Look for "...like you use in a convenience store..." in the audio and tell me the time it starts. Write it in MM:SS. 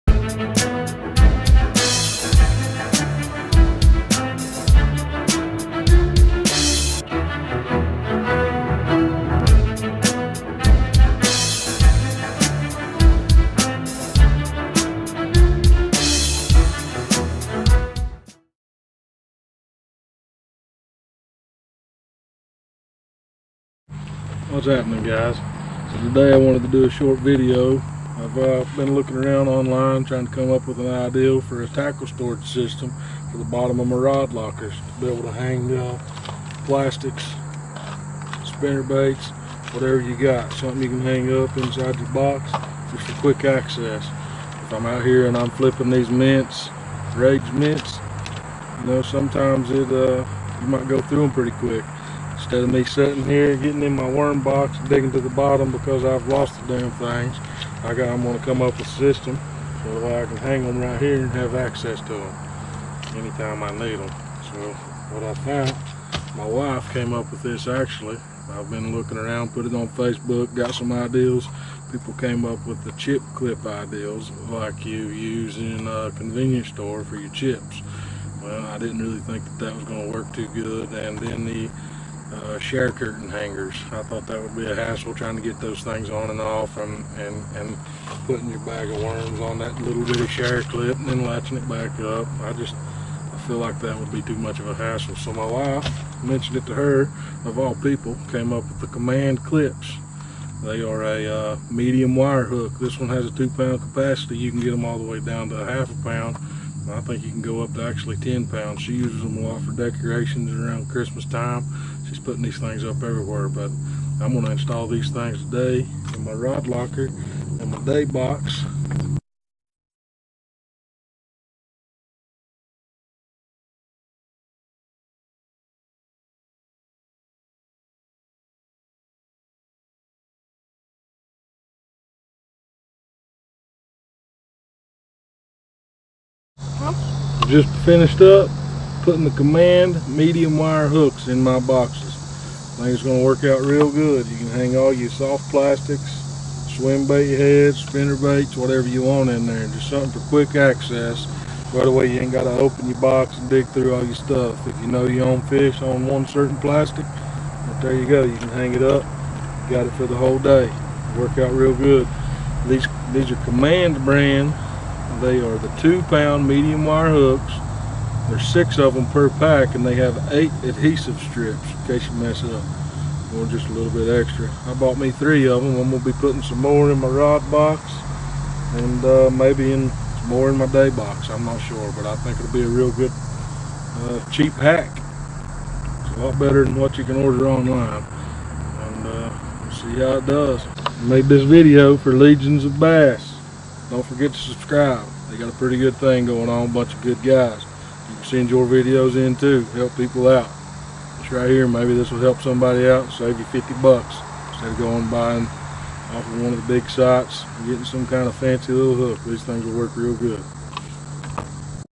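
01:14.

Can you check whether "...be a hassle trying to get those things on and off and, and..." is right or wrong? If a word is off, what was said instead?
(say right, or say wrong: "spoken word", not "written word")
right.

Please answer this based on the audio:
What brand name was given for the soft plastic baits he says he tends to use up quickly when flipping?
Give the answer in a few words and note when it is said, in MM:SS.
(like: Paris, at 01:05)
Rage, at 00:47.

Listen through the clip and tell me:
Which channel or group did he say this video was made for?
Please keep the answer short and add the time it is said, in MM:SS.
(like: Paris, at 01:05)
Legions of Bass, at 03:12.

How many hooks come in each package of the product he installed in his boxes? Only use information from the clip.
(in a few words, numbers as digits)
6.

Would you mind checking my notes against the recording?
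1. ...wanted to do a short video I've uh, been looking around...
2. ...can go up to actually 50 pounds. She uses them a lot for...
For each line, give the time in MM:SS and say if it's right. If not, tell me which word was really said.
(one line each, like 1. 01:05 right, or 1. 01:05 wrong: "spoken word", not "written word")
1. 00:26 right
2. 01:47 wrong: "10", not "50".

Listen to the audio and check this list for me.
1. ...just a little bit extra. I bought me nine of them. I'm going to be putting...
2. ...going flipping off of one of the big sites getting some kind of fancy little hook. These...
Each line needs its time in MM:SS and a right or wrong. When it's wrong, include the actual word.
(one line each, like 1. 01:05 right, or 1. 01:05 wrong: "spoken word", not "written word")
1. 02:53 wrong: "three", not "nine"
2. 03:24 wrong: "buying", not "flipping".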